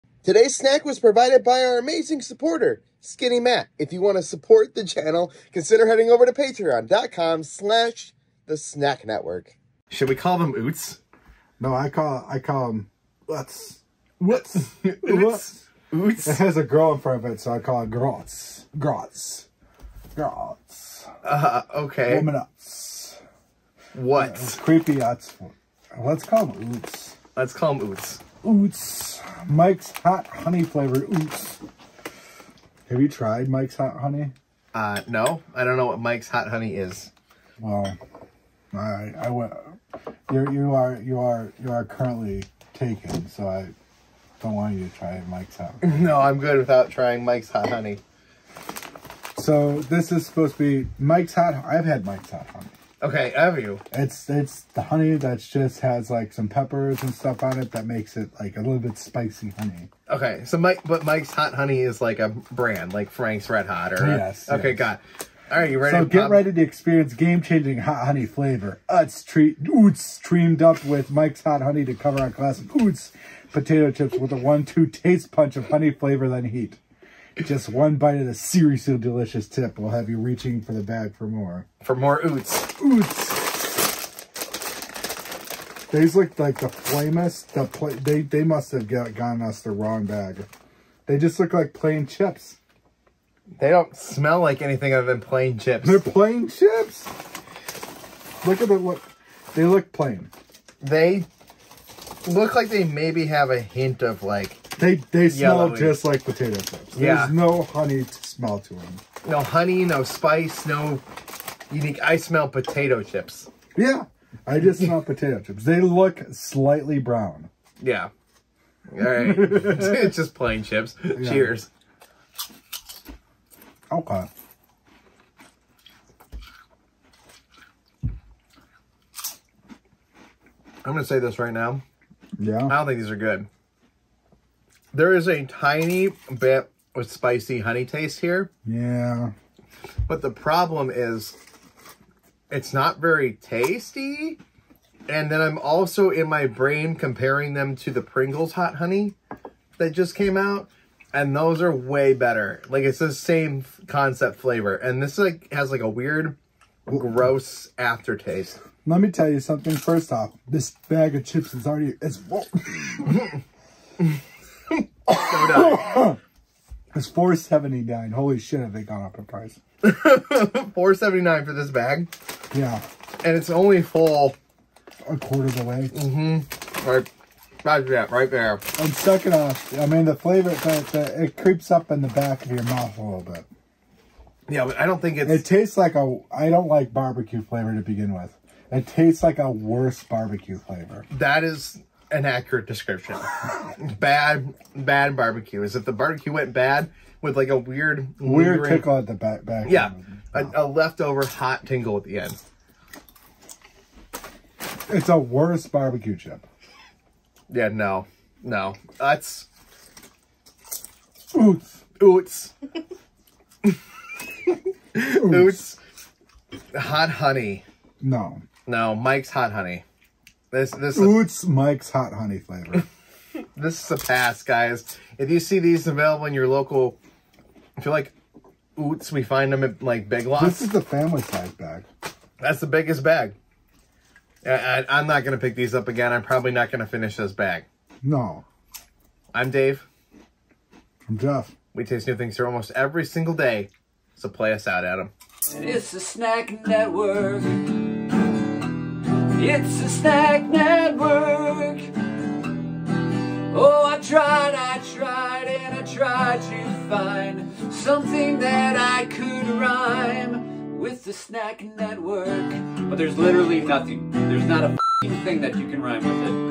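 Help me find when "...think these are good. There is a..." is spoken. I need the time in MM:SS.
02:12.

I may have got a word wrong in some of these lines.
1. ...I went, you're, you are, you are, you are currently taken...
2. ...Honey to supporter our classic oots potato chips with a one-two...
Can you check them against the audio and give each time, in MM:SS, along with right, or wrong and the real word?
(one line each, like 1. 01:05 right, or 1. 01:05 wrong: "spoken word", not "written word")
1. 00:39 right
2. 01:11 wrong: "cover", not "supporter".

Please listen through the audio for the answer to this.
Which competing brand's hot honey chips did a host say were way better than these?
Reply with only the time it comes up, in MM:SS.
02:28.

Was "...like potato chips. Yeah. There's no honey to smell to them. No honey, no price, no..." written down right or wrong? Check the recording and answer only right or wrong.
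wrong.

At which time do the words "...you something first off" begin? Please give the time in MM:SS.
02:39.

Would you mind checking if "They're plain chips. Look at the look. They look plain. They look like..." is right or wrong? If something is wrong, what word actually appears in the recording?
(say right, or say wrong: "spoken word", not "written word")
right.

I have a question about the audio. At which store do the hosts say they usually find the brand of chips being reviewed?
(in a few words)
Big Lots.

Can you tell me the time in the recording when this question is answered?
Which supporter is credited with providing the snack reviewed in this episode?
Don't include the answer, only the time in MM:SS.
00:02.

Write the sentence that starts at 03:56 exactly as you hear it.
I'm probably not gonna finish this bag.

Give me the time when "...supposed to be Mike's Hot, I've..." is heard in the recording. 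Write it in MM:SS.
00:50.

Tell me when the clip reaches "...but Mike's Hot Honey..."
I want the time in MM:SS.
01:00.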